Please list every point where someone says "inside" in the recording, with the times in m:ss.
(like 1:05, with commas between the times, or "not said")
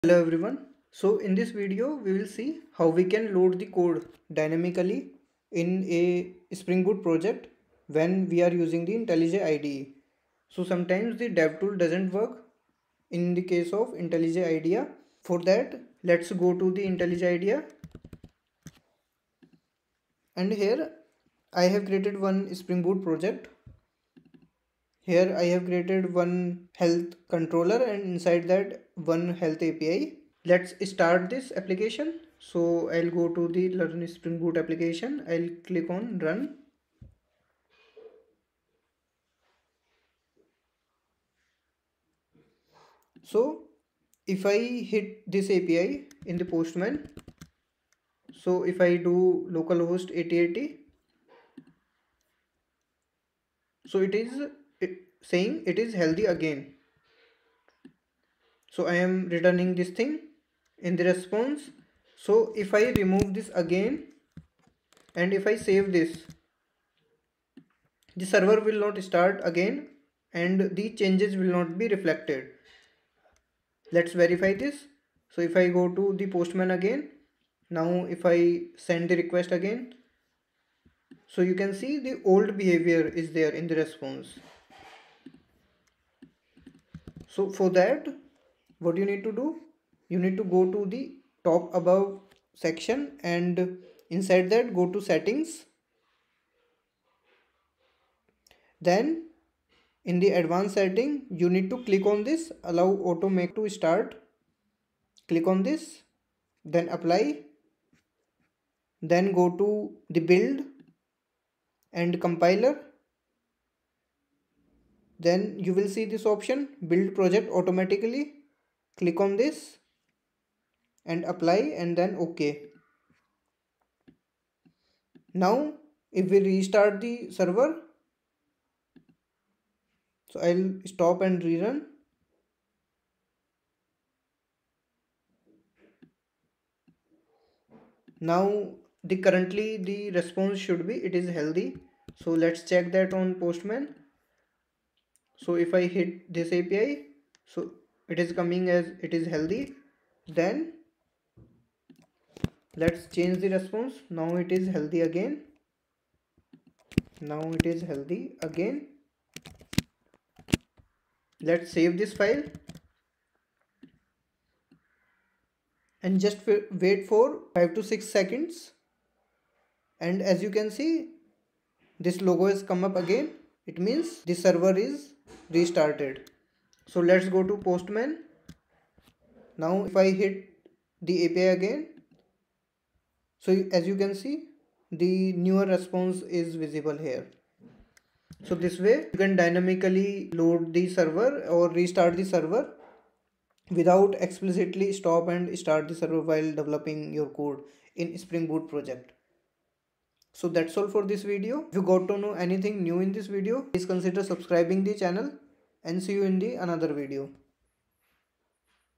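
0:28, 1:34.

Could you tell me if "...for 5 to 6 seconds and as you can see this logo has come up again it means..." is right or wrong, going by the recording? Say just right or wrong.
right.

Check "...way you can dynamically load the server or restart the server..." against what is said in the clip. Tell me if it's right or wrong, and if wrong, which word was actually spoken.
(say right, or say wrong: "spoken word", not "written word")
right.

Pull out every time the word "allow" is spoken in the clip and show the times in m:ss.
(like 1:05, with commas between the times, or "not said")
1:42.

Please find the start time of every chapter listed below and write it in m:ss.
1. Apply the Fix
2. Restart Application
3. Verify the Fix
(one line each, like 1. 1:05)
1. 1:26
2. 2:05
3. 2:32.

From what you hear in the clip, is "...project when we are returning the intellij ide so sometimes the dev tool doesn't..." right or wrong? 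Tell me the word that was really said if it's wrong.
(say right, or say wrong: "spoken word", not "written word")
wrong: "using", not "returning".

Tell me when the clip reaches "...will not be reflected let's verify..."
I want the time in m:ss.
1:11.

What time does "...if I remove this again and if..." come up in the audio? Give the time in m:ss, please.
1:02.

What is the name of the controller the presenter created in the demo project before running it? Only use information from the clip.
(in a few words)
health controller.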